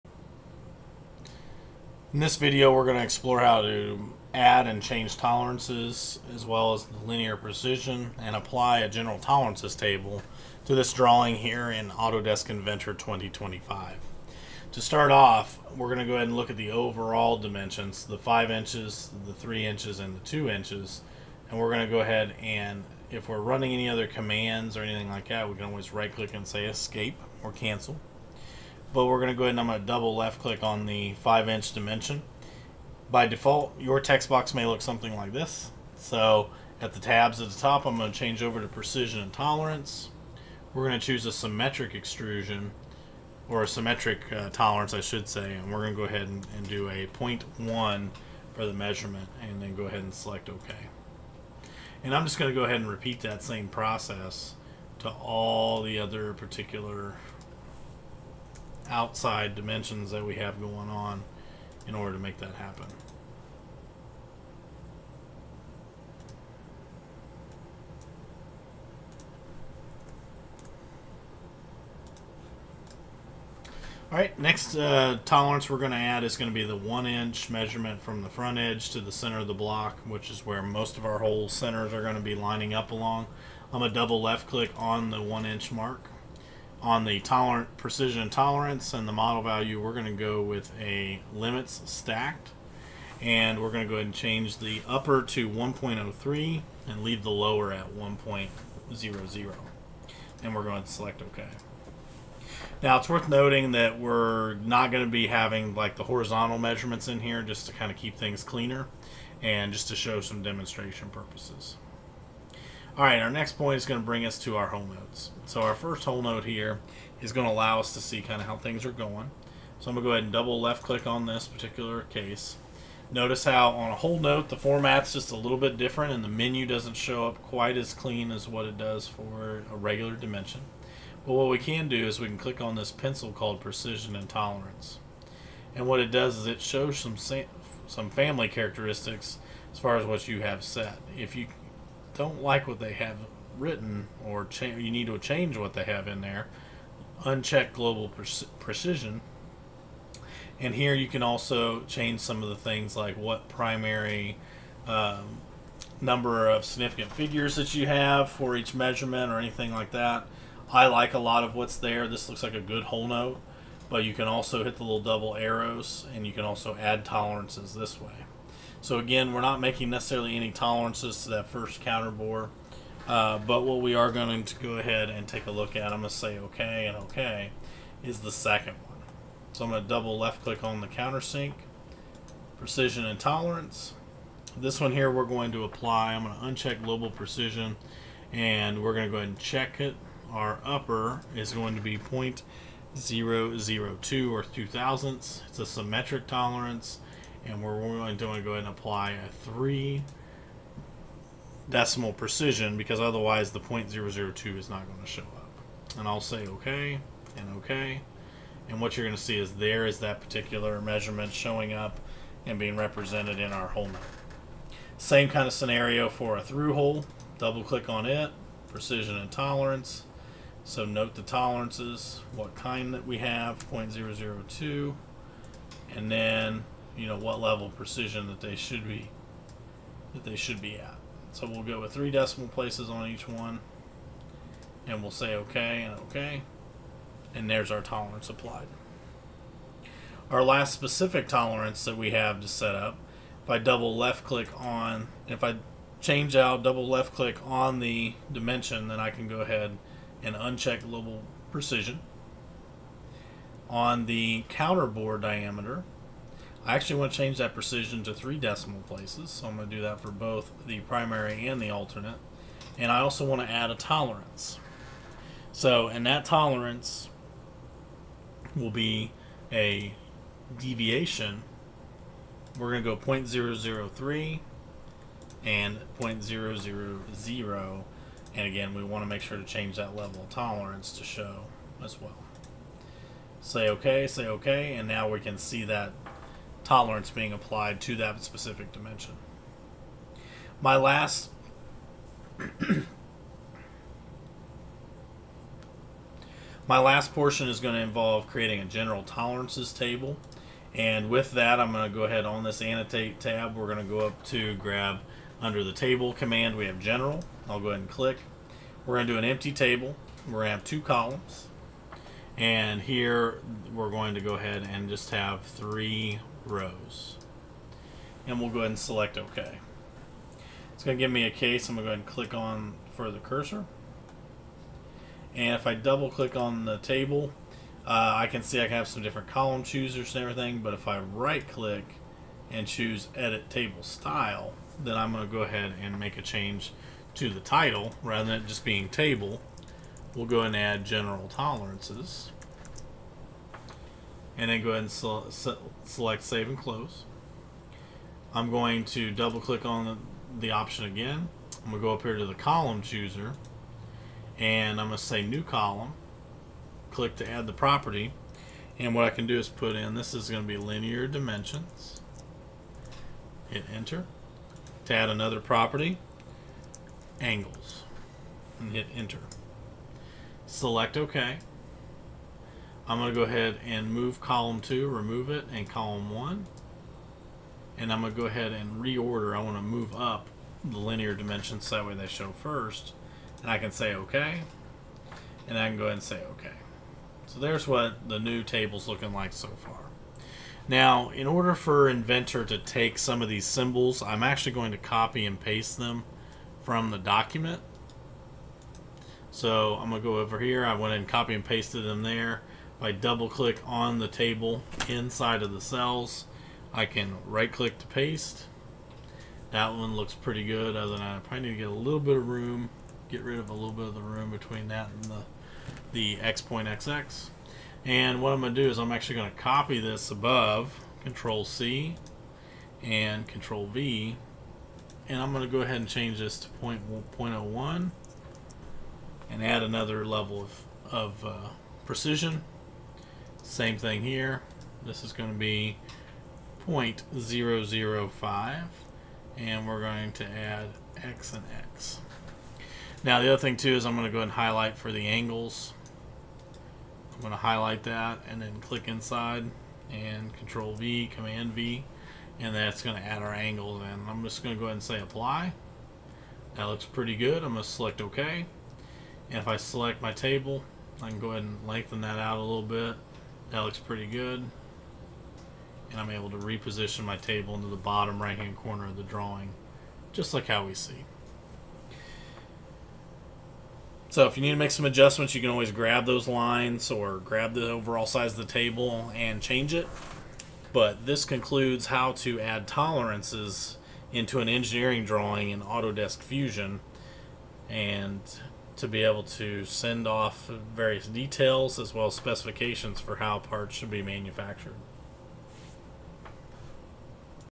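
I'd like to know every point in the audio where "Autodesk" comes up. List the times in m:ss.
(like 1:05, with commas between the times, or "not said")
0:11, 8:05.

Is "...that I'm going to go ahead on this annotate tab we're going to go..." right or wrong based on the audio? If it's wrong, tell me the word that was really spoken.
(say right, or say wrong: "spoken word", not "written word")
right.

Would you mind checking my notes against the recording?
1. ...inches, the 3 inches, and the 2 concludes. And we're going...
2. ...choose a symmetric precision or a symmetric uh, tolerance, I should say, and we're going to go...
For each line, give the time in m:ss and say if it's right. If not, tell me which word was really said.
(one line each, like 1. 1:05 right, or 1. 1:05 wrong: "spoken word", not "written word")
1. 0:18 wrong: "inches", not "concludes"
2. 0:41 wrong: "extrusion", not "precision".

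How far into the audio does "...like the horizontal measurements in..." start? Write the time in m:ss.
1:45.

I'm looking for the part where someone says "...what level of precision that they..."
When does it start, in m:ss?
3:47.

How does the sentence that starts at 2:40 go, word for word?
I like a lot of what's there.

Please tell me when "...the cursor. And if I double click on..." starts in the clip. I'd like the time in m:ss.
5:23.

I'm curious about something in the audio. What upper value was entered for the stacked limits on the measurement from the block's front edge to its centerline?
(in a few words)
1.03.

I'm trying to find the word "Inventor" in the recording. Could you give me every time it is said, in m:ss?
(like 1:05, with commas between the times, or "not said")
0:12, 6:31.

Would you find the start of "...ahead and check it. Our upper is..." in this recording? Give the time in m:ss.
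3:09.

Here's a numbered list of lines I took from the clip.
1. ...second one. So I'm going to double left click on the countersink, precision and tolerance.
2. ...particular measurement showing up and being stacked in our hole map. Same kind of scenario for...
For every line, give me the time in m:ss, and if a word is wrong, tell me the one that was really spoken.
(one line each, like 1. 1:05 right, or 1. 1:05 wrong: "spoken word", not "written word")
1. 2:58 right
2. 3:30 wrong: "represented", not "stacked".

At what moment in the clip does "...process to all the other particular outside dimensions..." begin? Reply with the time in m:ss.
0:53.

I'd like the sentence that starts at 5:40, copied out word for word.
We'll go and add general tolerances and then go ahead and se select save and close.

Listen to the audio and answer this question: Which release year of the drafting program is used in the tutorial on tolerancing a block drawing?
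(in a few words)
2025.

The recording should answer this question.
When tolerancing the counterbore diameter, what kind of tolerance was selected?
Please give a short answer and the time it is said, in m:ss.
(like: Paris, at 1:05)
deviation, at 4:30.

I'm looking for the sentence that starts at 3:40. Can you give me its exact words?
So note the tolerances, what kind that we have, 0.002.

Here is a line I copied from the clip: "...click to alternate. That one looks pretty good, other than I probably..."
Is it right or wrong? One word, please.
wrong.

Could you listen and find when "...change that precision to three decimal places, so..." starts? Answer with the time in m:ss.
4:17.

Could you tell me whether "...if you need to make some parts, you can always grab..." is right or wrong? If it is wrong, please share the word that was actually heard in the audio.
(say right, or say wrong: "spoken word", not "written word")
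wrong: "adjustments", not "parts".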